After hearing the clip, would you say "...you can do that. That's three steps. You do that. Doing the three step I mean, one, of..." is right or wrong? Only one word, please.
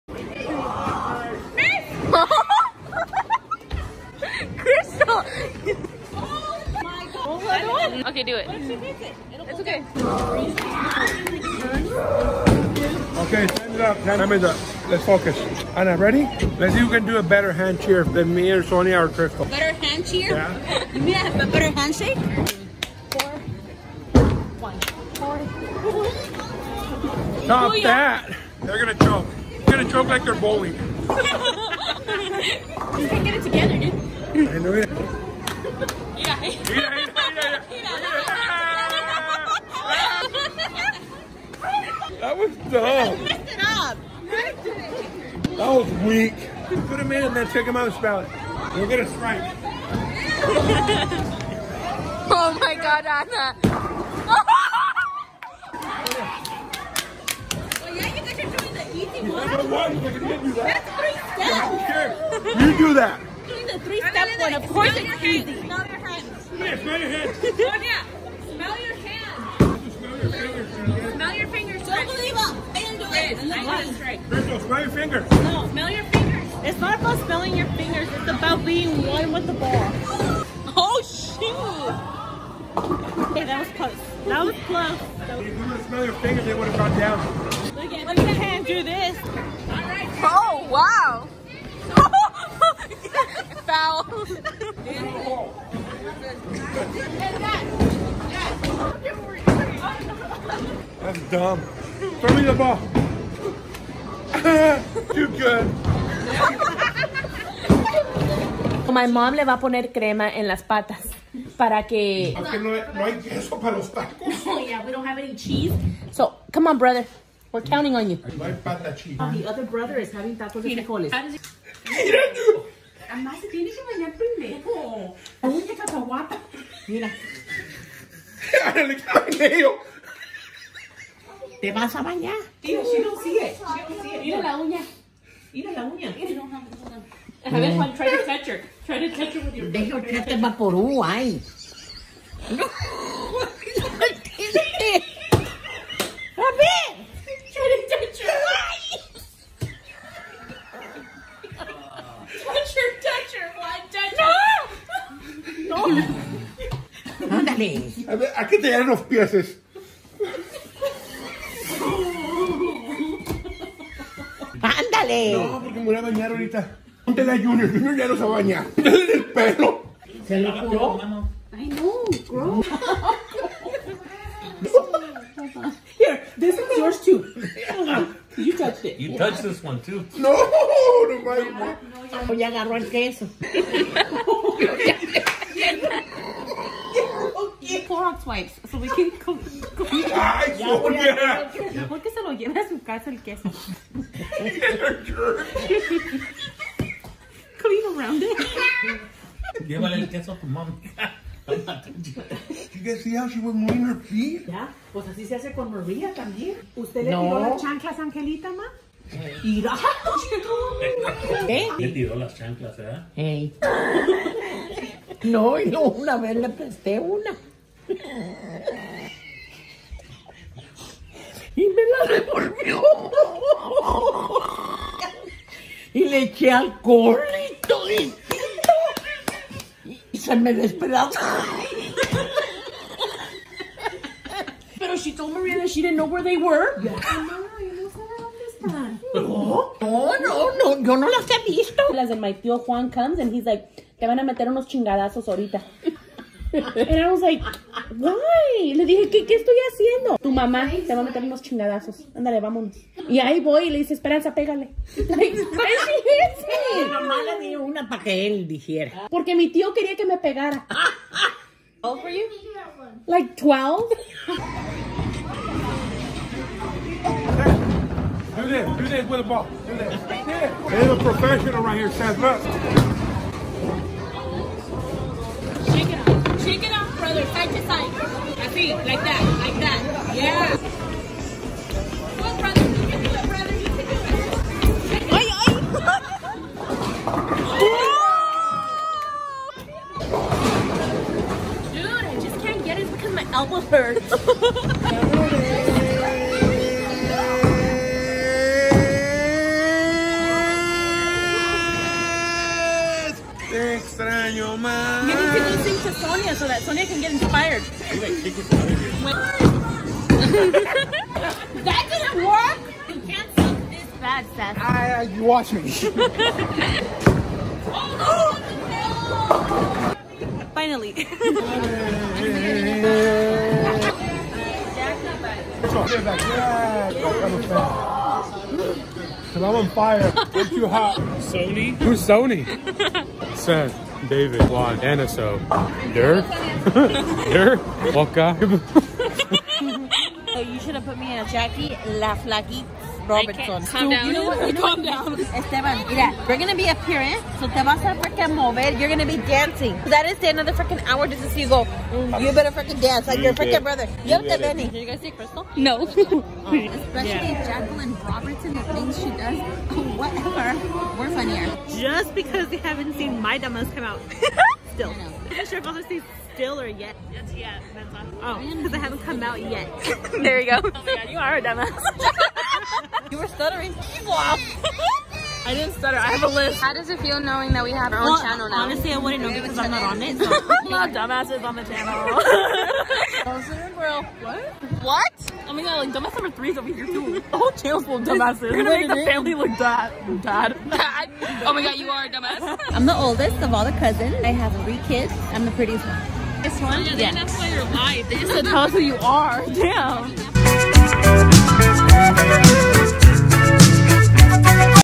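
right.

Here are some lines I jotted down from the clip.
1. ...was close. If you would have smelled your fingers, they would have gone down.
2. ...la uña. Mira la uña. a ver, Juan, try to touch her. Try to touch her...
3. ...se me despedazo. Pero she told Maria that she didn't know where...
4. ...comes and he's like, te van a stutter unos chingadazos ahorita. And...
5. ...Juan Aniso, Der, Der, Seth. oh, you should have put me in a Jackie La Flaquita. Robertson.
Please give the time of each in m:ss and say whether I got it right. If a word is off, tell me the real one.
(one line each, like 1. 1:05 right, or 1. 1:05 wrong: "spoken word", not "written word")
1. 1:24 right
2. 2:14 right
3. 3:50 right
4. 4:02 wrong: "meter", not "stutter"
5. 5:34 wrong: "Waka", not "Seth".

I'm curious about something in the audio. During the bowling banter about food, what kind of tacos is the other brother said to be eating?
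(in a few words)
tacos de frijoles.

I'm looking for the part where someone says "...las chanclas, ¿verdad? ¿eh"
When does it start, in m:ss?
3:32.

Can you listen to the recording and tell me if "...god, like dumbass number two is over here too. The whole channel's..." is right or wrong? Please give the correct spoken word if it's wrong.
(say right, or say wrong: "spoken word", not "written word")
wrong: "three", not "two".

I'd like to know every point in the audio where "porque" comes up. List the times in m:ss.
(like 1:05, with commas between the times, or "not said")
2:45, 4:19.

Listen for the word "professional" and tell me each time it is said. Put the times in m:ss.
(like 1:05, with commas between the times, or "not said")
4:31.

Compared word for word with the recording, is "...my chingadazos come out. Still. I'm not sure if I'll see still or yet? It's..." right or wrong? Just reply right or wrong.
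wrong.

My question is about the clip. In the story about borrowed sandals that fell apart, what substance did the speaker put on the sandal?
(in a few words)
alcohol.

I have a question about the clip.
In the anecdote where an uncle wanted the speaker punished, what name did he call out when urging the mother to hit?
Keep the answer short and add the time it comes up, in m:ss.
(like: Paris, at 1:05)
Esperanza, at 4:13.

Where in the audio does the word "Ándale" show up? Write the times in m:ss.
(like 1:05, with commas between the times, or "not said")
2:37, 4:12.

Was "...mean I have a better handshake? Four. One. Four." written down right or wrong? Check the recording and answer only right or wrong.
right.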